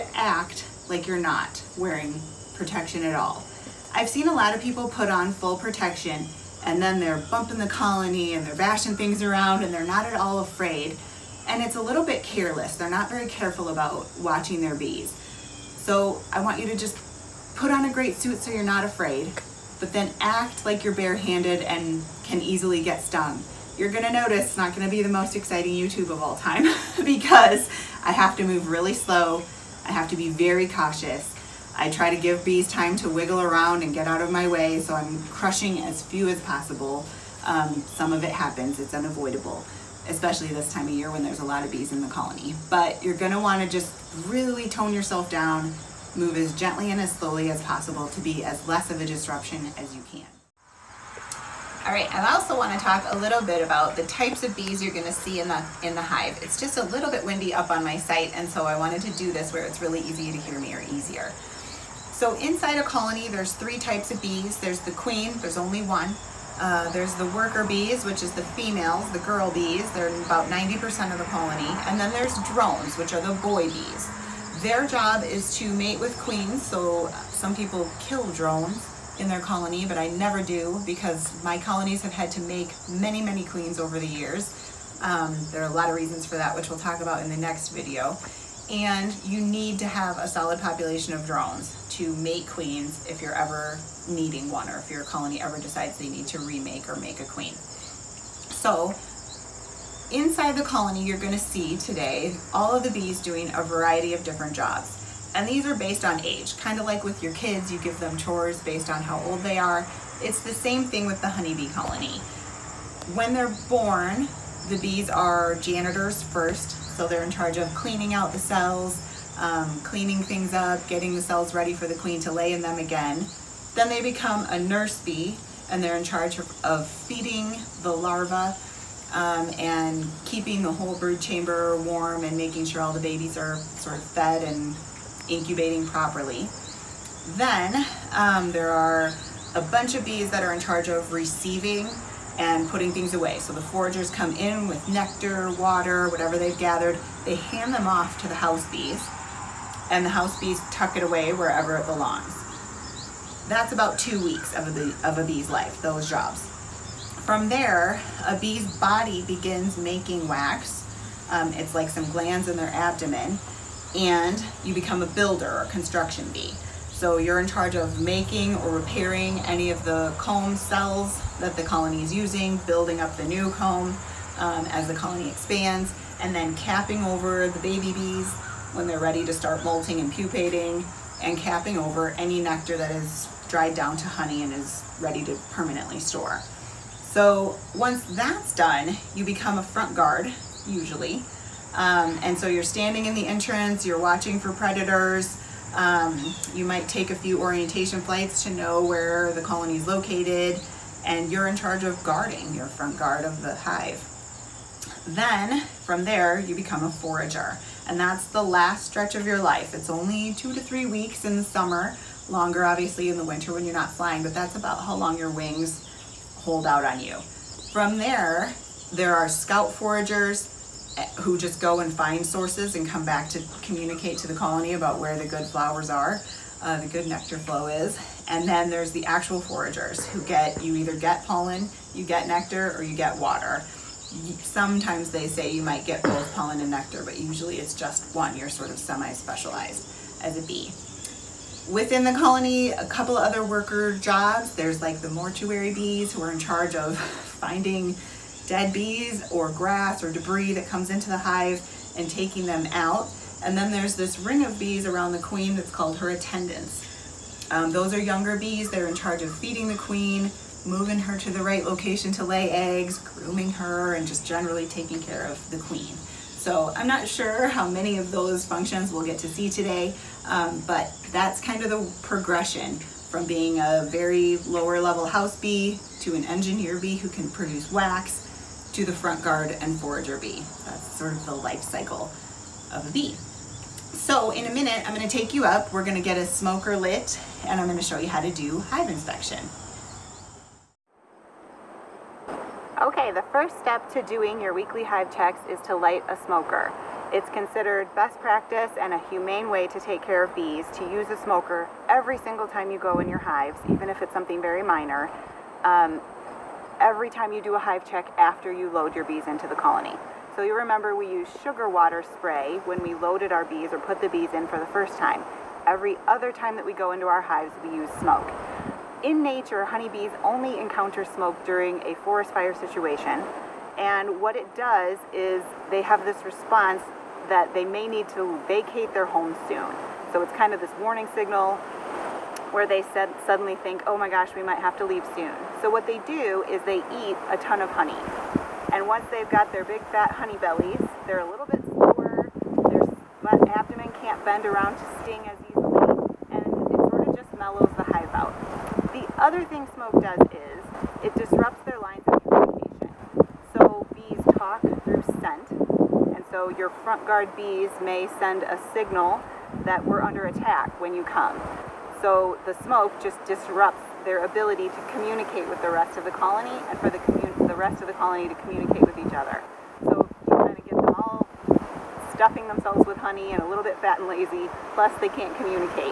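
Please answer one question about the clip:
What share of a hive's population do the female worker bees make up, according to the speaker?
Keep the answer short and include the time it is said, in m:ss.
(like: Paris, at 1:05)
90%, at 1:10.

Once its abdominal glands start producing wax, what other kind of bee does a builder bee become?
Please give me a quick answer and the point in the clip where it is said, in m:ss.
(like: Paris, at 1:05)
construction bee, at 2:45.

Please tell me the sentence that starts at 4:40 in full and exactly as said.
That's sort of the life cycle of a bee.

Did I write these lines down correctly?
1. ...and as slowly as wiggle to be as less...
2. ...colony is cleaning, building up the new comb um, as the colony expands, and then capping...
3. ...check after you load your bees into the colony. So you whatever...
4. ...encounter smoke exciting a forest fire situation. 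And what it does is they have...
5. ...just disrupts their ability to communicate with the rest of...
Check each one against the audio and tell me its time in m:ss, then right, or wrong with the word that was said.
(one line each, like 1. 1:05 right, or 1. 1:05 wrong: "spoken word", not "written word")
1. 0:46 wrong: "possible", not "wiggle"
2. 2:51 wrong: "using", not "cleaning"
3. 5:07 wrong: "remember", not "whatever"
4. 5:20 wrong: "during", not "exciting"
5. 6:03 right.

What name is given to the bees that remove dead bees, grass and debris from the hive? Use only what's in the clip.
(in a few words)
mortuary bees.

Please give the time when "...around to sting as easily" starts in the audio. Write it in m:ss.
5:44.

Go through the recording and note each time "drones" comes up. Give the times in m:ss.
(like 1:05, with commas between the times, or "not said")
1:12, 1:18, 1:31.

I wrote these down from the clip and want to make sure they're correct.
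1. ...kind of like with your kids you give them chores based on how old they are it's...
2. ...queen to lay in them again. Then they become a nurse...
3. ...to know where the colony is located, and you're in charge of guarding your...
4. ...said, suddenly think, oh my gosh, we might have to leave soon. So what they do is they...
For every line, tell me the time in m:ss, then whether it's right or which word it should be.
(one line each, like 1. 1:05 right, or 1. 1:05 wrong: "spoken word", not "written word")
1. 1:46 right
2. 2:01 right
3. 3:18 right
4. 5:32 right.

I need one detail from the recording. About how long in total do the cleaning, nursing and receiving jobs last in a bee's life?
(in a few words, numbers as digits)
two weeks.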